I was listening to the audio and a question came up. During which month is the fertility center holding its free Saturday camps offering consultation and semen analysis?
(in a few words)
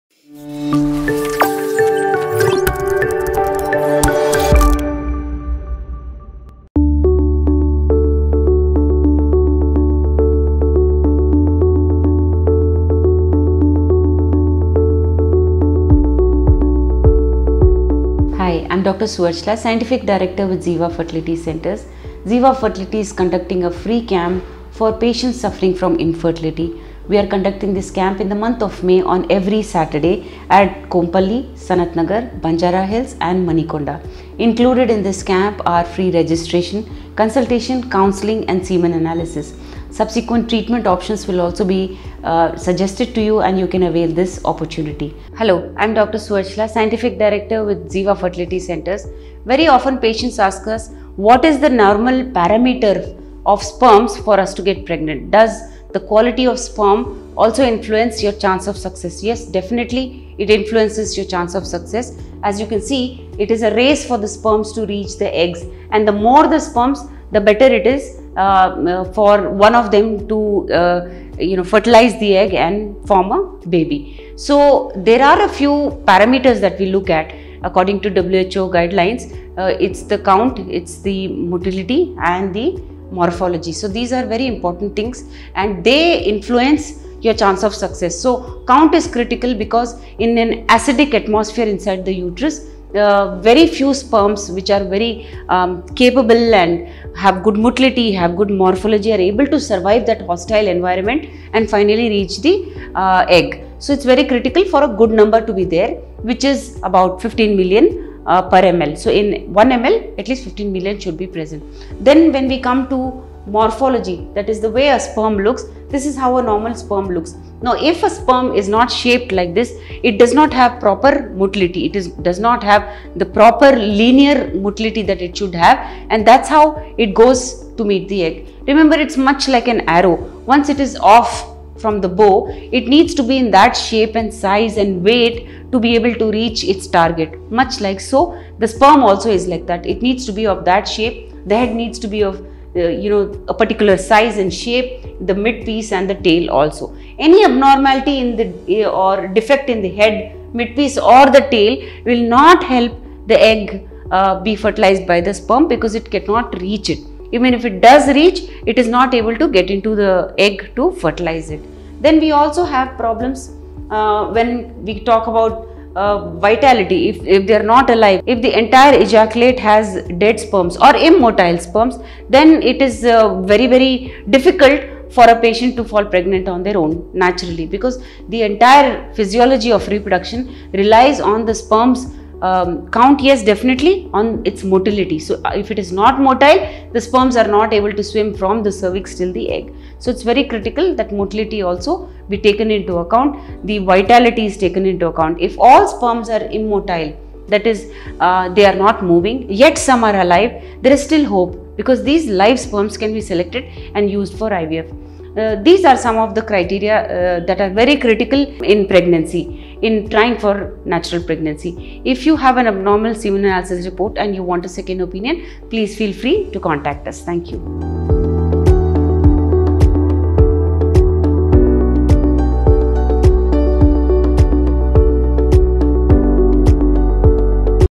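May.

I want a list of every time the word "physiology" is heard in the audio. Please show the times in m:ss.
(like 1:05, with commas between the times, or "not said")
2:59.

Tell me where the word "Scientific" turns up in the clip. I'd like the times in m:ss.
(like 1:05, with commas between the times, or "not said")
0:19, 0:46.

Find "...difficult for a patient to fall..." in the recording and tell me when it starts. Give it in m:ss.
2:54.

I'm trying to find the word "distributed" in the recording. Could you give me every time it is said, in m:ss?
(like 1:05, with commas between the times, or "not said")
not said.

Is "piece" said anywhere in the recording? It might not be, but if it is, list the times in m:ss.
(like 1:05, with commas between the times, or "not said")
2:25, 2:30.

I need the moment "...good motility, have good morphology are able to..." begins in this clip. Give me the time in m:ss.
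1:37.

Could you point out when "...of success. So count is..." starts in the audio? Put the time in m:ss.
1:27.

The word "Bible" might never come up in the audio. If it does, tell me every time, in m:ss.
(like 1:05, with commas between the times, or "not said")
not said.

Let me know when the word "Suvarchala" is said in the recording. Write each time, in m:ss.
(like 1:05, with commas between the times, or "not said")
0:19, 0:46.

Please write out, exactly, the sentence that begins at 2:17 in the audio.
Much like so, the sperm also is like that.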